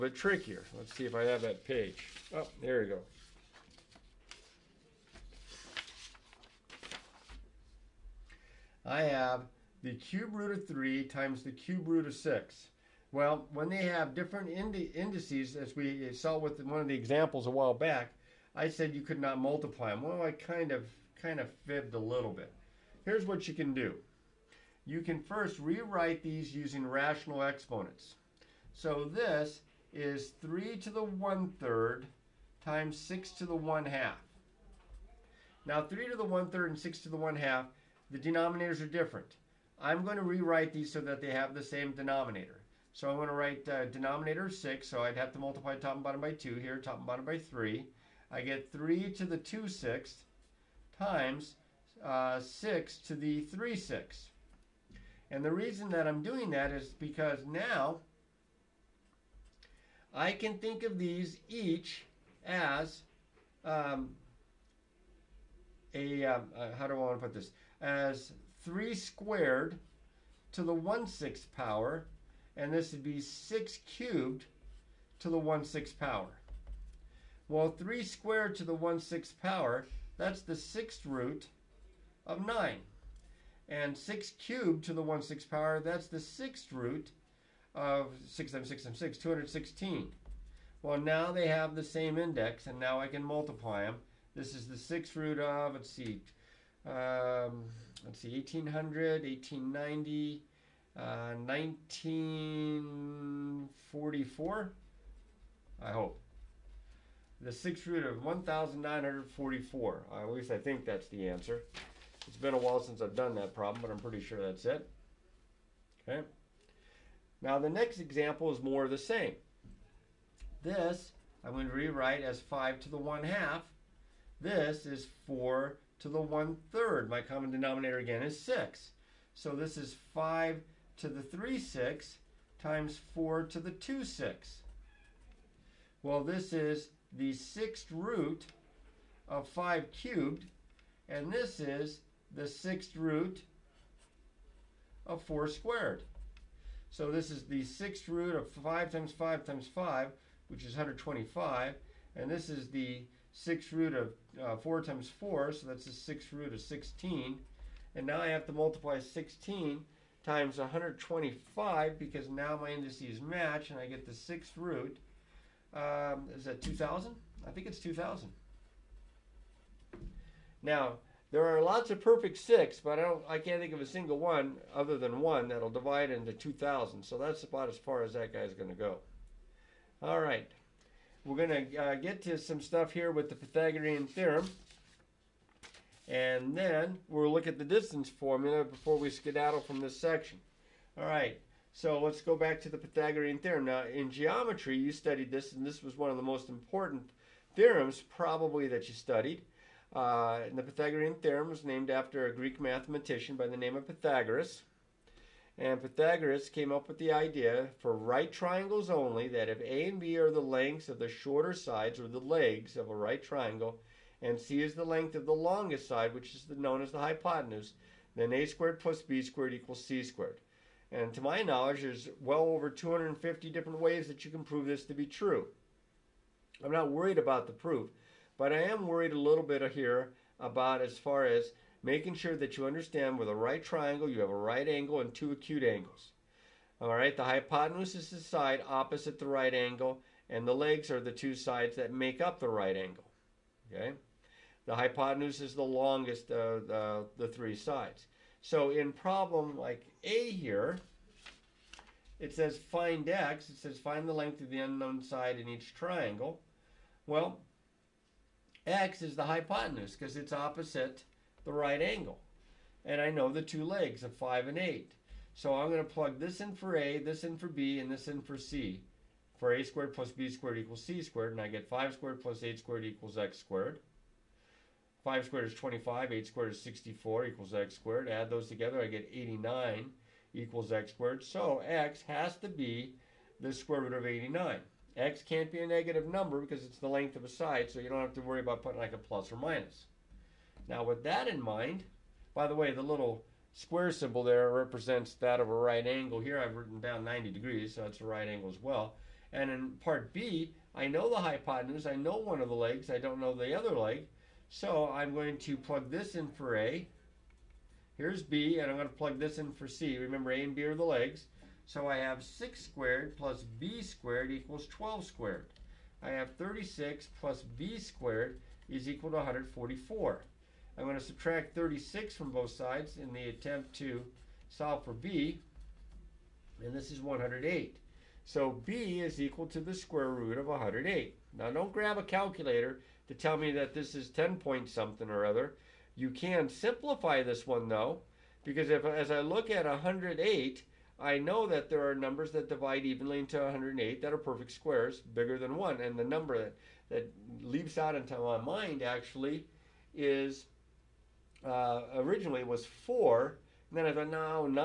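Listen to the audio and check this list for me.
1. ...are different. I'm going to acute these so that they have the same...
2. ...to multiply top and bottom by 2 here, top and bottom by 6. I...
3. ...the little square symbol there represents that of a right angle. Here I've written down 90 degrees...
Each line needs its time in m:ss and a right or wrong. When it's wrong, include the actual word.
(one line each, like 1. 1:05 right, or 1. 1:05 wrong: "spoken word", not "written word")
1. 0:38 wrong: "rewrite", not "acute"
2. 0:45 wrong: "3", not "6"
3. 4:52 right.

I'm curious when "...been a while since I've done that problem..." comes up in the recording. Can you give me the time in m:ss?
1:52.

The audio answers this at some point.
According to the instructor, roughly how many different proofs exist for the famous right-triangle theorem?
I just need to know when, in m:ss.
3:42.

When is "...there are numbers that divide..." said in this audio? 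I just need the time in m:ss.
5:41.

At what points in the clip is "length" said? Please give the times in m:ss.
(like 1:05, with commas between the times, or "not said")
3:30, 3:34, 4:14, 4:46.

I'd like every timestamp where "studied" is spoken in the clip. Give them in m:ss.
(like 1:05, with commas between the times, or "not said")
3:14, 3:18.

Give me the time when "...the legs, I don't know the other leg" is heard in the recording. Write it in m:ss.
5:02.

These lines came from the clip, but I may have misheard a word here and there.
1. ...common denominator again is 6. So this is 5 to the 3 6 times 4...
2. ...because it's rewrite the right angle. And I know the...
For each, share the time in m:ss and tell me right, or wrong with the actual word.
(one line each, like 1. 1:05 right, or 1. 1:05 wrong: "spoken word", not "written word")
1. 2:07 right
2. 4:19 wrong: "opposite", not "rewrite".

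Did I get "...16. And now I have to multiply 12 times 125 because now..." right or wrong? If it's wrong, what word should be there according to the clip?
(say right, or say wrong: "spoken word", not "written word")
wrong: "16", not "12".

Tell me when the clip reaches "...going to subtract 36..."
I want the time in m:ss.
5:20.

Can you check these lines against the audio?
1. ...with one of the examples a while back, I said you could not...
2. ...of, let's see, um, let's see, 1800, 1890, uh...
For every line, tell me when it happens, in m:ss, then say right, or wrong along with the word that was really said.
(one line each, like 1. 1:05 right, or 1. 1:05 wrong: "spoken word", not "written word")
1. 0:16 right
2. 1:35 right.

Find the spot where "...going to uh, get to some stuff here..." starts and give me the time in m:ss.
3:01.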